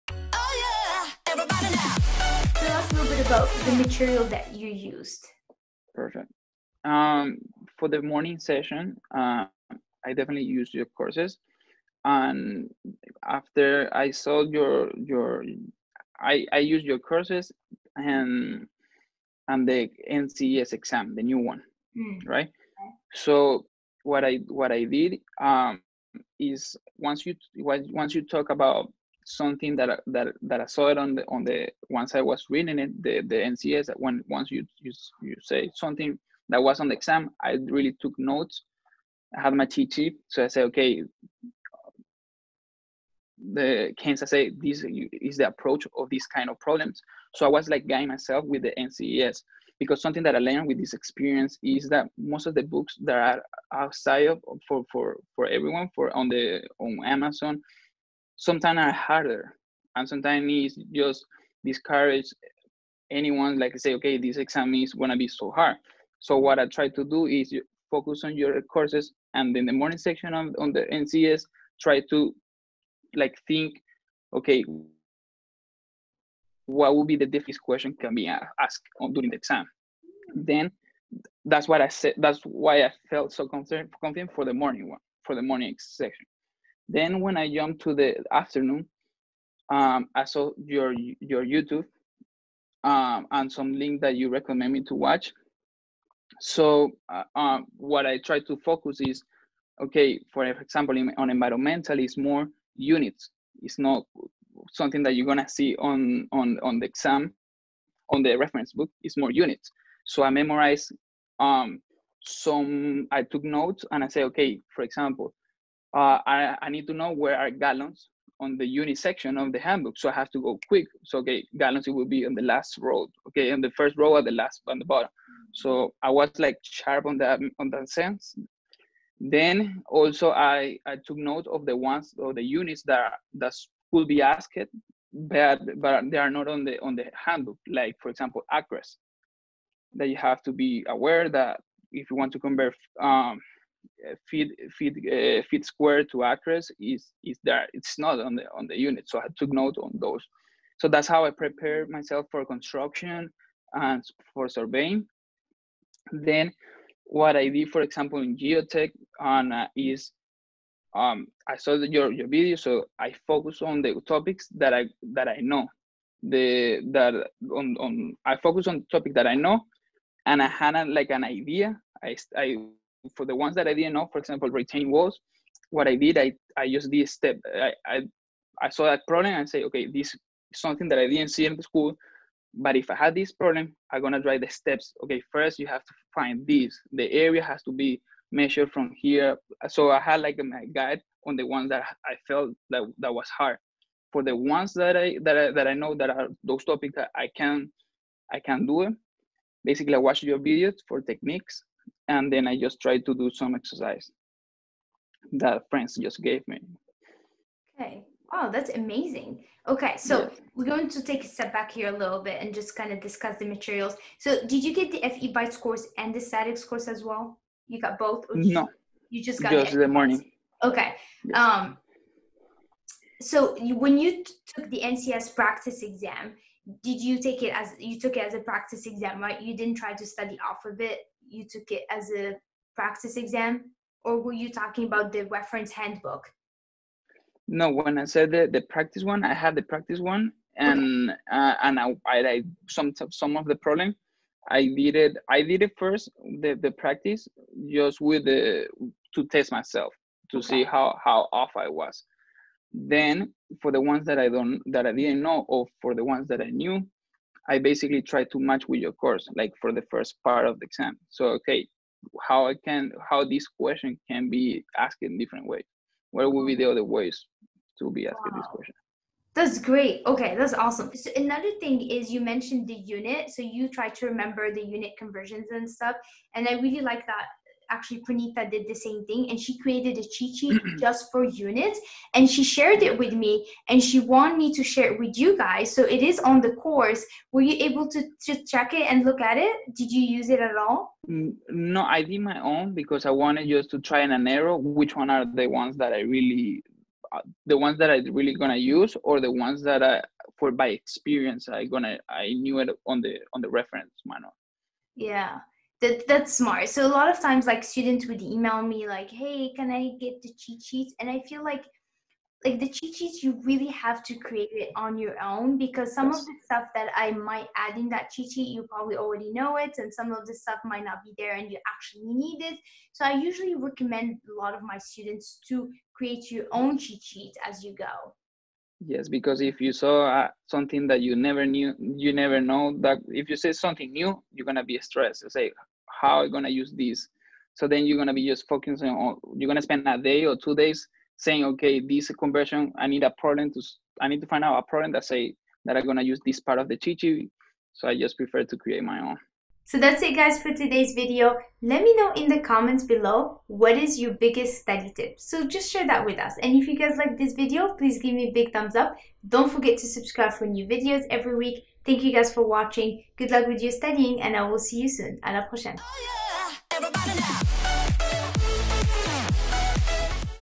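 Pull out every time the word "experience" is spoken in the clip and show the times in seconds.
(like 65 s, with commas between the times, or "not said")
50 s, 300 s.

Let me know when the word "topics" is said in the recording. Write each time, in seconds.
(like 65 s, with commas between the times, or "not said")
164 s, 168 s, 196 s.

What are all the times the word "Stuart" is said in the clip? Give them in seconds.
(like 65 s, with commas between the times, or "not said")
not said.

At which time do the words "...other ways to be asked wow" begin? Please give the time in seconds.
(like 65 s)
266 s.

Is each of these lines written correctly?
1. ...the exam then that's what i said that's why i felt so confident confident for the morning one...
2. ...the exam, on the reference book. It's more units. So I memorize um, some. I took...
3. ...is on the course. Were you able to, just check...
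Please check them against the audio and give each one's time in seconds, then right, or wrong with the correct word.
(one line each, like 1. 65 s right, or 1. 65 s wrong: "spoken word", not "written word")
1. 79 s right
2. 106 s right
3. 286 s right.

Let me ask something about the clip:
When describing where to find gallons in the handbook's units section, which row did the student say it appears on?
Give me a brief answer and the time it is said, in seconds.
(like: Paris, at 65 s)
last row, at 122 s.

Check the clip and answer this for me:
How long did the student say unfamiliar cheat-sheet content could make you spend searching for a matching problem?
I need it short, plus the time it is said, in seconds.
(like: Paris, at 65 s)
a day or two days, at 339 s.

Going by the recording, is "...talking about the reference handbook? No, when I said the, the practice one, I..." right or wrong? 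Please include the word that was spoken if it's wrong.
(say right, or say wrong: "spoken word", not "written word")
right.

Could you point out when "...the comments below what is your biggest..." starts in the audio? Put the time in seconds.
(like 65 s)
352 s.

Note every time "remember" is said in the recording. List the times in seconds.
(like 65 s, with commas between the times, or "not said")
274 s.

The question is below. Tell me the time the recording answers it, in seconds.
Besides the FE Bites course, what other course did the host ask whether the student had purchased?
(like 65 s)
216 s.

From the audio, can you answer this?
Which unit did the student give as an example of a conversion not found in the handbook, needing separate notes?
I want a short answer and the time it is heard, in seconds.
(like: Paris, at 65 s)
acres, at 138 s.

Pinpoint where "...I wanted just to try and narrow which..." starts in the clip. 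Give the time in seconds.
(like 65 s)
293 s.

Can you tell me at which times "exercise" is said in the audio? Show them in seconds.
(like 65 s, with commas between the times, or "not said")
203 s.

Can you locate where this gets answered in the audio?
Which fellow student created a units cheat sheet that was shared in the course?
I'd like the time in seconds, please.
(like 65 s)
278 s.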